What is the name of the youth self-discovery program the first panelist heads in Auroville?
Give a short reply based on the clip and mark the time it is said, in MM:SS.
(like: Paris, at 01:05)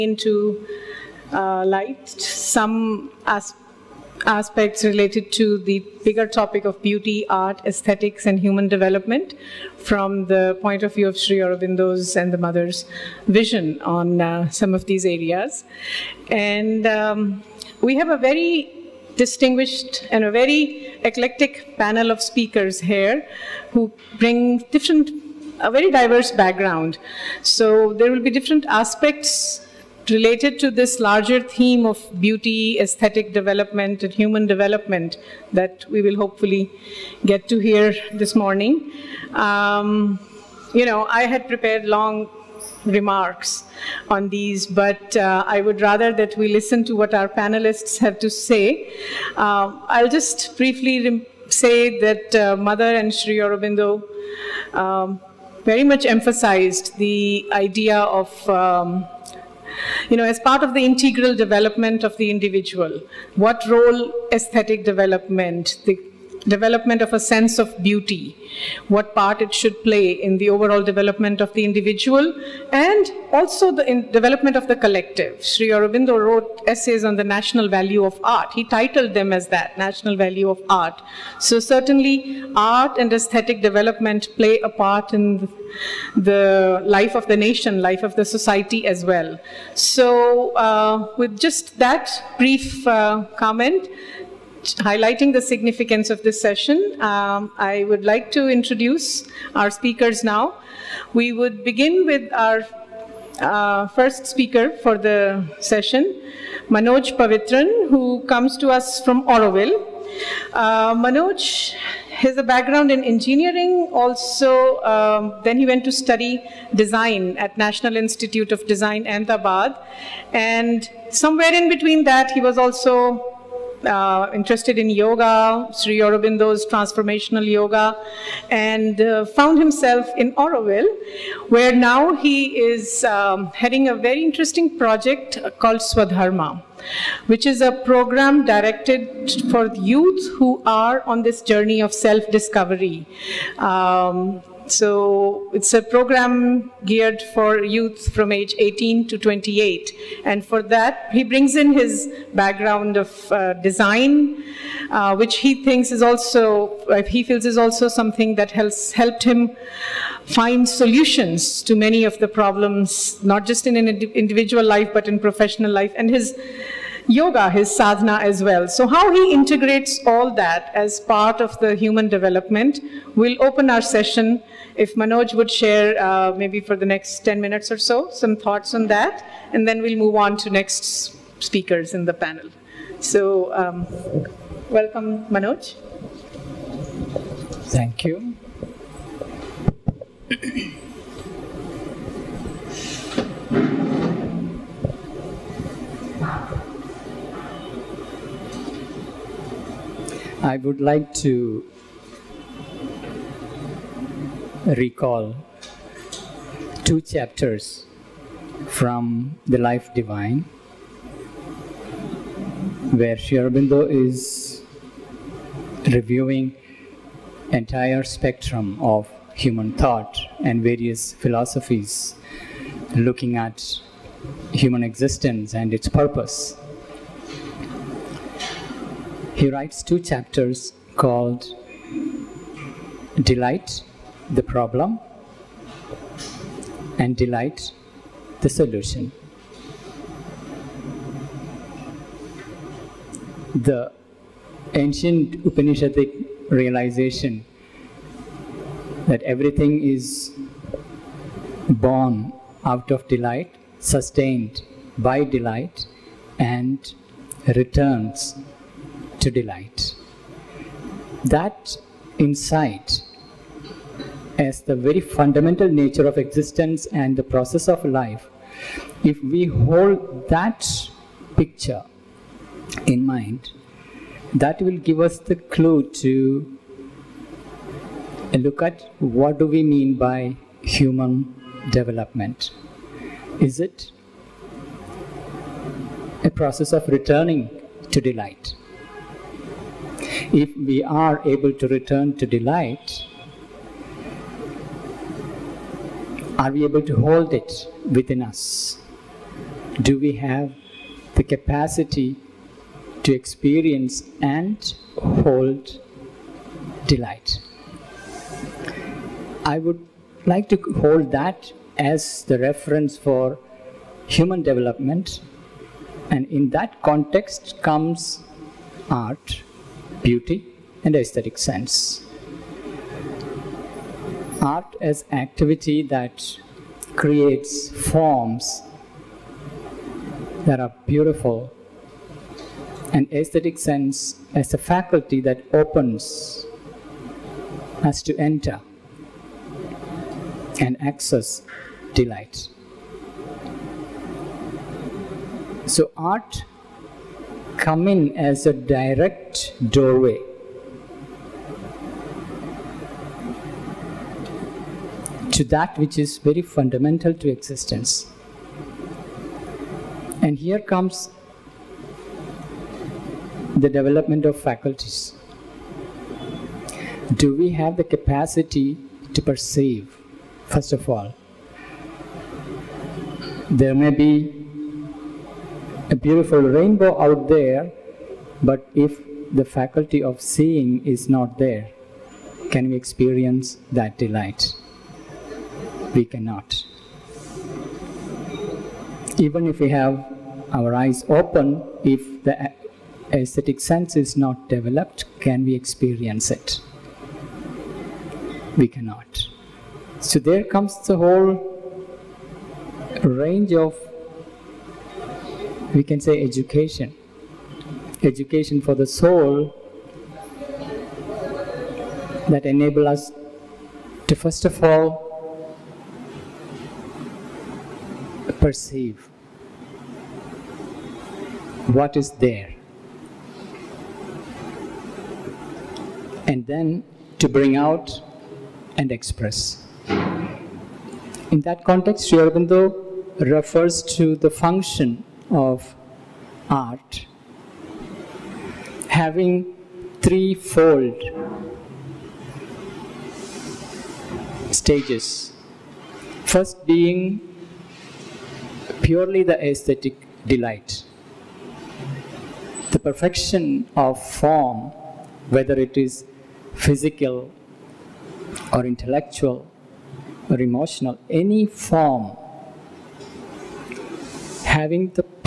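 Swadharma, at 02:15.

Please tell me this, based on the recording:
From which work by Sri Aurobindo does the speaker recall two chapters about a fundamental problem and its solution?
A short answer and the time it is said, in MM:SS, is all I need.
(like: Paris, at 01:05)
The Life Divine, at 03:29.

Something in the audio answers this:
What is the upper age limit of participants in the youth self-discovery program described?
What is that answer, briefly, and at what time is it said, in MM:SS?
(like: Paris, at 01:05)
28, at 02:29.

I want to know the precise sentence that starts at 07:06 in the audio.
And then to bring out and express.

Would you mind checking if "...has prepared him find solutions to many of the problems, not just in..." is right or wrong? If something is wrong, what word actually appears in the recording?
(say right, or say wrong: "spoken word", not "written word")
wrong: "helped", not "prepared".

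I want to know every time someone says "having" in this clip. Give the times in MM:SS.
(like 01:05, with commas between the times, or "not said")
07:18, 07:44.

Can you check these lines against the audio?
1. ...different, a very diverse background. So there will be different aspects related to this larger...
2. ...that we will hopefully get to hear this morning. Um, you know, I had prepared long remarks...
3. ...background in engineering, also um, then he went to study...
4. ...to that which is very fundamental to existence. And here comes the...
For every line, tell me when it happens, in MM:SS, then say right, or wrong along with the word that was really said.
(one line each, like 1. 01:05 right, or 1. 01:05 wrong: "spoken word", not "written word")
1. 00:24 right
2. 00:35 right
3. 01:52 right
4. 05:55 right.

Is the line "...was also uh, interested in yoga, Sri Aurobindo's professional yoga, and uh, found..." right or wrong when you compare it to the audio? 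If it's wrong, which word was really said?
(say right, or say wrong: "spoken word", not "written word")
wrong: "transformational", not "professional".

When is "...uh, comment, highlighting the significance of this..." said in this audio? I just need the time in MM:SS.
01:32.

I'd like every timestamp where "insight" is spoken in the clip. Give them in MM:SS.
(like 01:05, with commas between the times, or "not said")
04:22.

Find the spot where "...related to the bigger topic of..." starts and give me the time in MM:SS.
00:04.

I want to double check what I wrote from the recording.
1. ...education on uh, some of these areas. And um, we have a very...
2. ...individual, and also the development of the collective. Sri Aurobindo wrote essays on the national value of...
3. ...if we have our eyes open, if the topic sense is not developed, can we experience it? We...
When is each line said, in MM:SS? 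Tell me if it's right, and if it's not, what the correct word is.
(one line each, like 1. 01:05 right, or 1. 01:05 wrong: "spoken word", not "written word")
1. 00:13 wrong: "vision", not "education"
2. 01:11 right
3. 06:29 wrong: "aesthetic", not "topic".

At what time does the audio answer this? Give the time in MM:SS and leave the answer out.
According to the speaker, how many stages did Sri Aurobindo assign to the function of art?
07:20.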